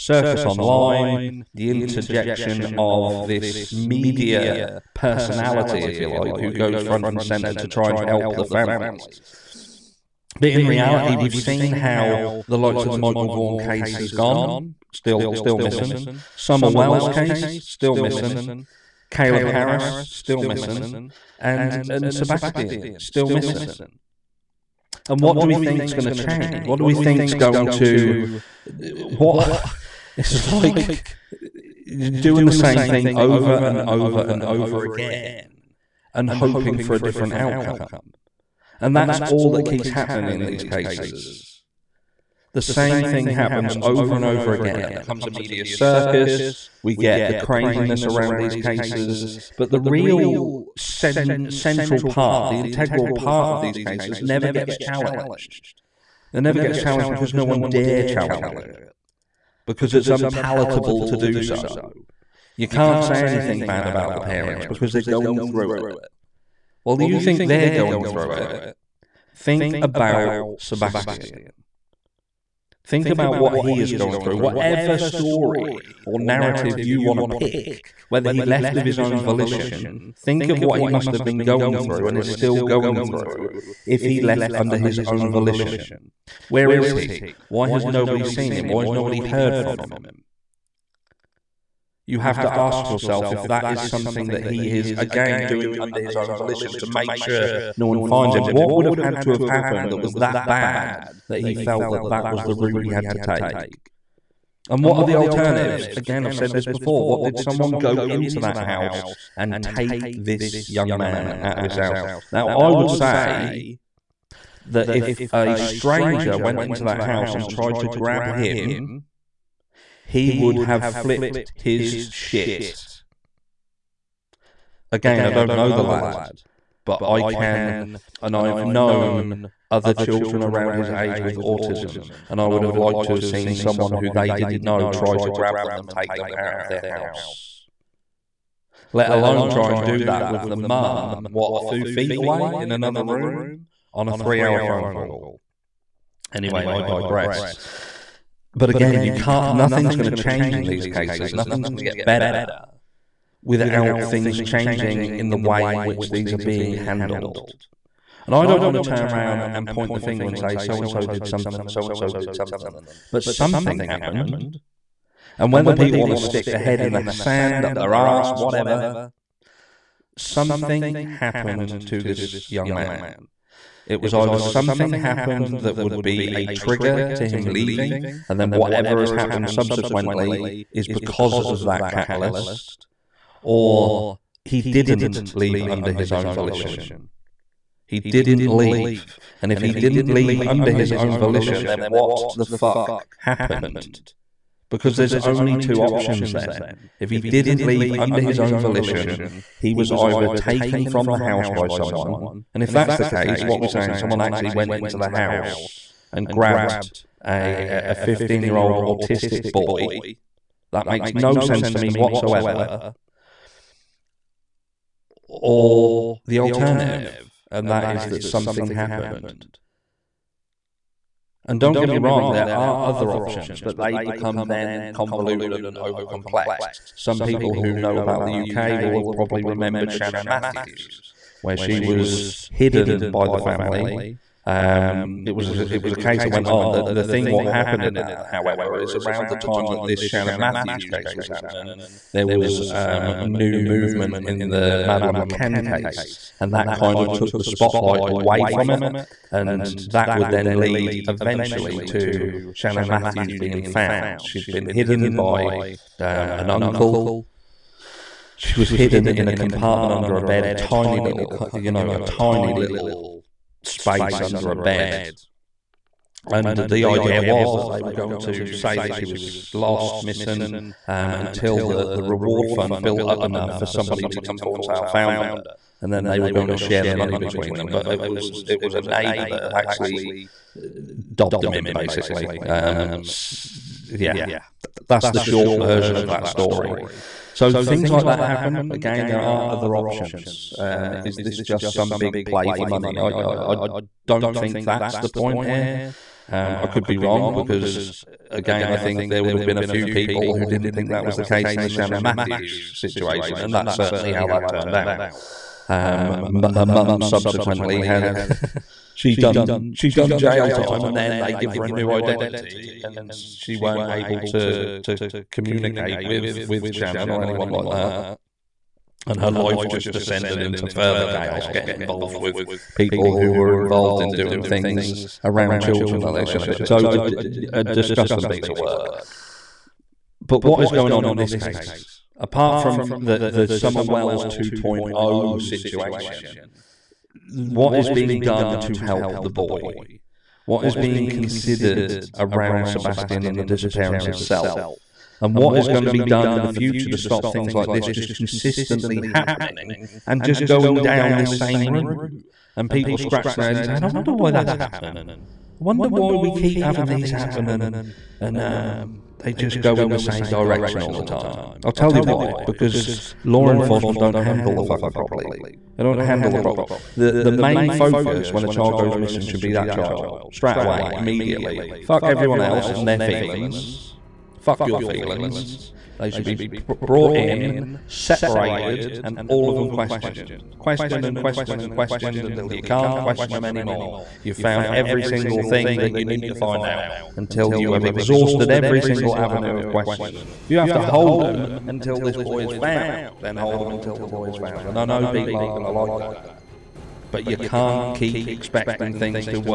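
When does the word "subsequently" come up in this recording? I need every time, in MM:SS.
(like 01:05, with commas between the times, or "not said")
02:59, 05:07.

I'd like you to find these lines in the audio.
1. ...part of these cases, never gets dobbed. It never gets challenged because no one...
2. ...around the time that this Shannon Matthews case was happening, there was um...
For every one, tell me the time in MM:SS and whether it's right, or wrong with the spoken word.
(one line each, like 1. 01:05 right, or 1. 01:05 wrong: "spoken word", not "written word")
1. 00:53 wrong: "challenged", not "dobbed"
2. 03:58 right.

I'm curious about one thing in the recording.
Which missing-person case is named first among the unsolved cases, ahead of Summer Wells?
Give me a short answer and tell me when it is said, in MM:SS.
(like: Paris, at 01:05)
Michael Vaughan, at 00:12.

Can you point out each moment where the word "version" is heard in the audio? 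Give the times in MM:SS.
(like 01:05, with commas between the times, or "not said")
04:45.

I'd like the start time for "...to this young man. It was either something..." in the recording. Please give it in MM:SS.
02:51.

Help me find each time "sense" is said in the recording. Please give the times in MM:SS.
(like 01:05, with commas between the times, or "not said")
03:31.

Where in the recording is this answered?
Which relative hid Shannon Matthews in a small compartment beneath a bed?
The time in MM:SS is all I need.
04:16.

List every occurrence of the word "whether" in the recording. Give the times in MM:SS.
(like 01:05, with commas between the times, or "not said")
01:18, 02:45.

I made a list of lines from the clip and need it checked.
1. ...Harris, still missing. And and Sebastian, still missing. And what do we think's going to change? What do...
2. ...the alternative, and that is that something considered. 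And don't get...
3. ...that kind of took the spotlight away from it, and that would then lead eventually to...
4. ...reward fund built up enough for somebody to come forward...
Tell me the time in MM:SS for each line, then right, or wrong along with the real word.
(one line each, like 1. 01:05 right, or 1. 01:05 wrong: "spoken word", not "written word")
1. 00:19 right
2. 03:36 wrong: "happened", not "considered"
3. 04:06 right
4. 04:32 right.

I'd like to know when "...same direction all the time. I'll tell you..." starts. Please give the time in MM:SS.
05:59.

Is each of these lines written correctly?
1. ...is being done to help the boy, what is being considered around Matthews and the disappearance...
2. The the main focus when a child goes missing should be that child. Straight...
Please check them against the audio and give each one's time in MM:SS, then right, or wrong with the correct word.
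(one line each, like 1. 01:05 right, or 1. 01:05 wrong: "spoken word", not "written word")
1. 05:37 wrong: "Sebastian", not "Matthews"
2. 06:06 right.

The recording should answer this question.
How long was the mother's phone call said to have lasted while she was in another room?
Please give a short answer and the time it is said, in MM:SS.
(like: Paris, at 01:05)
3 hours, at 02:24.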